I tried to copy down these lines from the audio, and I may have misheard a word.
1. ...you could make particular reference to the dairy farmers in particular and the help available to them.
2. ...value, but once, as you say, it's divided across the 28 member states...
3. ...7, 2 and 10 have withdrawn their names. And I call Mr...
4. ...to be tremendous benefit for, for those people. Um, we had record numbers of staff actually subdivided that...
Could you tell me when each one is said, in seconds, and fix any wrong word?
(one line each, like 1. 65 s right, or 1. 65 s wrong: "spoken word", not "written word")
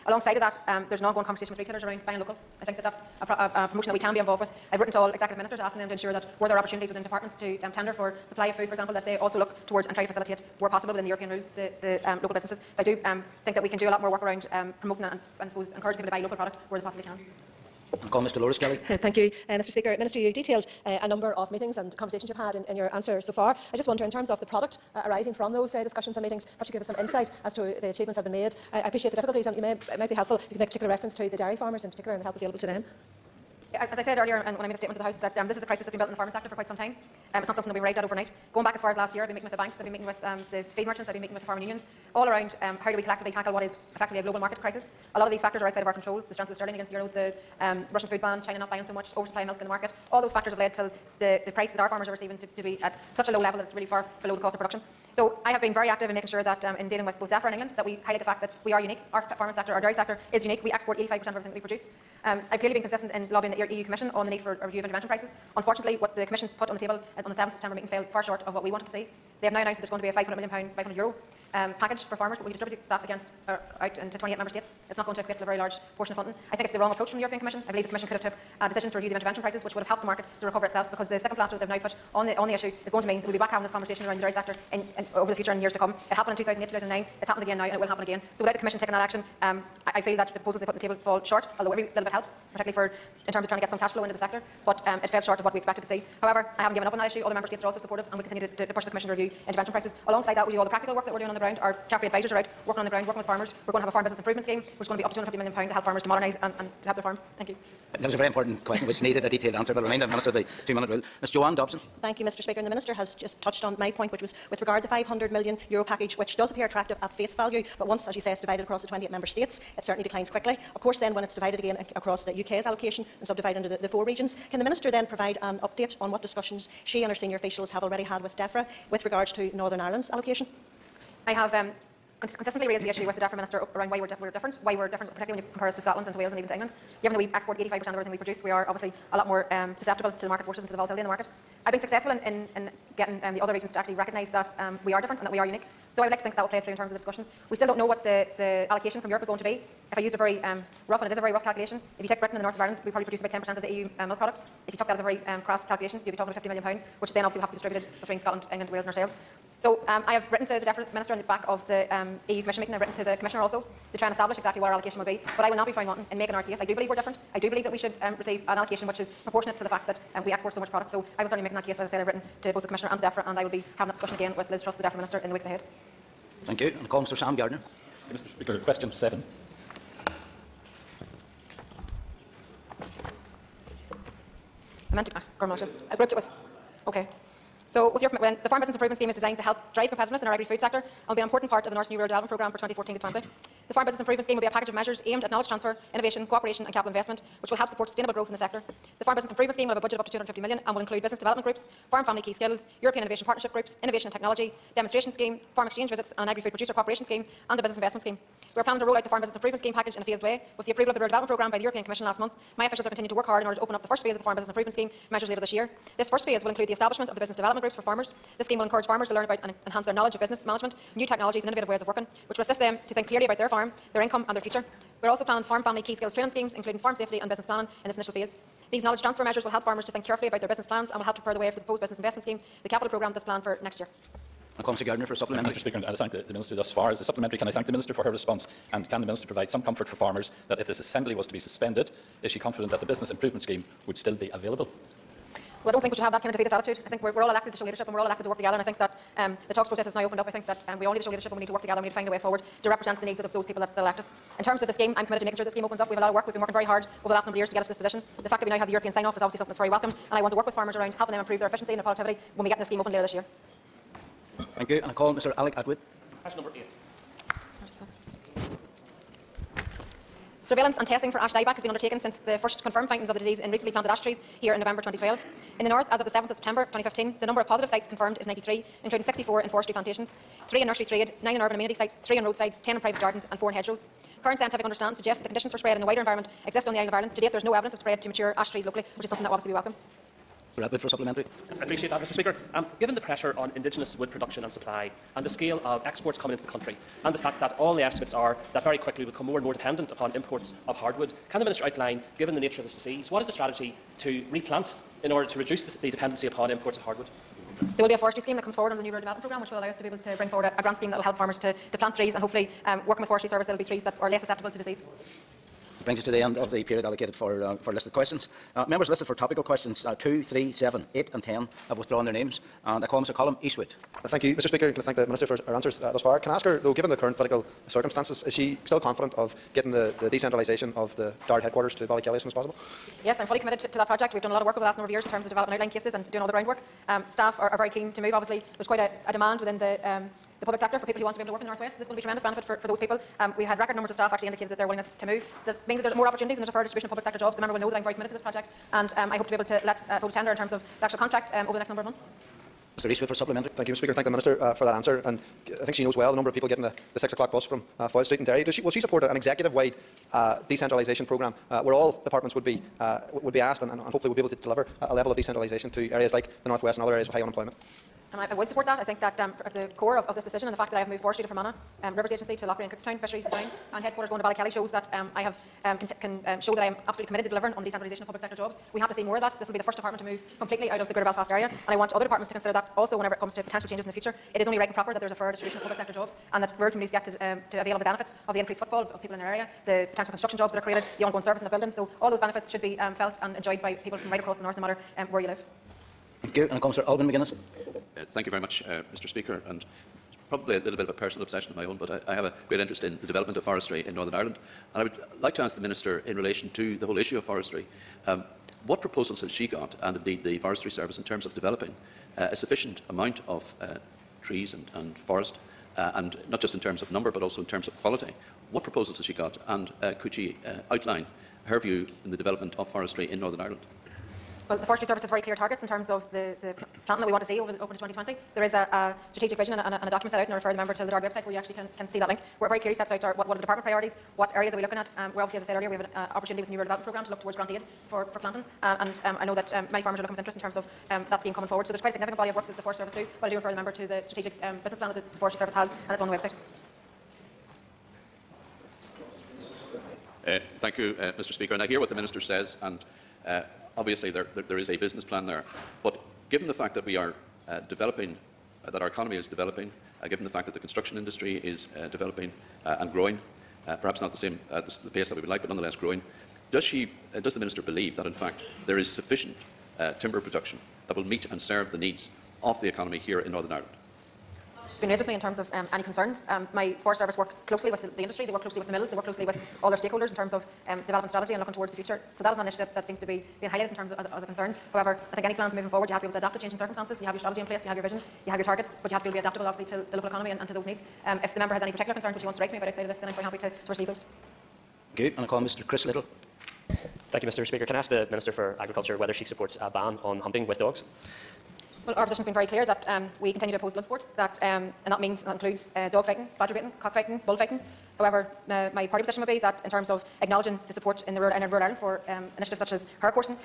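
1. 30 s right
2. 117 s right
3. 320 s wrong: "8", not "2"
4. 341 s wrong: "indicated", not "subdivided".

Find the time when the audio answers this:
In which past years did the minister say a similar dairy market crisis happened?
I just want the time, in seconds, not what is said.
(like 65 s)
86 s.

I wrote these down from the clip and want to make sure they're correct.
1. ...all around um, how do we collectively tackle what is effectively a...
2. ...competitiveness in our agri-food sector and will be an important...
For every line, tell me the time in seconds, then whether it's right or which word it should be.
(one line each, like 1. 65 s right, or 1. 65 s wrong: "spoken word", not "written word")
1. 42 s right
2. 189 s right.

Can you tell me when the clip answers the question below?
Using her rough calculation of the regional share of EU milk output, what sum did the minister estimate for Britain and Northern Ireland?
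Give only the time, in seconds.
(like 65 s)
156 s.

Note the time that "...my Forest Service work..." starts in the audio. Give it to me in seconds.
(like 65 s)
476 s.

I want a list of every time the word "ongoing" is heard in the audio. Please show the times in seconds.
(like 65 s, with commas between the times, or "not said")
1 s, 391 s.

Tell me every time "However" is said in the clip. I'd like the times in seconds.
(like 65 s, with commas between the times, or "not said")
96 s, 484 s, 507 s.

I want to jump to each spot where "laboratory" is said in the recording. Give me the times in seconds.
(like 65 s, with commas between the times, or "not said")
not said.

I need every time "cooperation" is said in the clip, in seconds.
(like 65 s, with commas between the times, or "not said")
196 s, 206 s.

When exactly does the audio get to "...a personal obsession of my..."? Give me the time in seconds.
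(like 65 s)
400 s.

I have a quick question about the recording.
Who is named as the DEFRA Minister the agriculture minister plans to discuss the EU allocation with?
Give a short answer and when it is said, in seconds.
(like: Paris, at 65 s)
Liz Truss, at 174 s.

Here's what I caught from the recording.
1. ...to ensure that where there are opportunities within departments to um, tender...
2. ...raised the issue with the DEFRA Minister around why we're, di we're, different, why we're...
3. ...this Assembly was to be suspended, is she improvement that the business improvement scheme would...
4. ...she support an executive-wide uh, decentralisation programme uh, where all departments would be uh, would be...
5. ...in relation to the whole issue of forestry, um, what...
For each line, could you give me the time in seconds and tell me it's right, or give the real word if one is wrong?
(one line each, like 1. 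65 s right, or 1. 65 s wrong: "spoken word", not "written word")
1. 5 s right
2. 132 s right
3. 240 s wrong: "confident", not "improvement"
4. 358 s right
5. 406 s right.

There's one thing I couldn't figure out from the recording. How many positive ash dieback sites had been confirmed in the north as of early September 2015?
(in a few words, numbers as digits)
93.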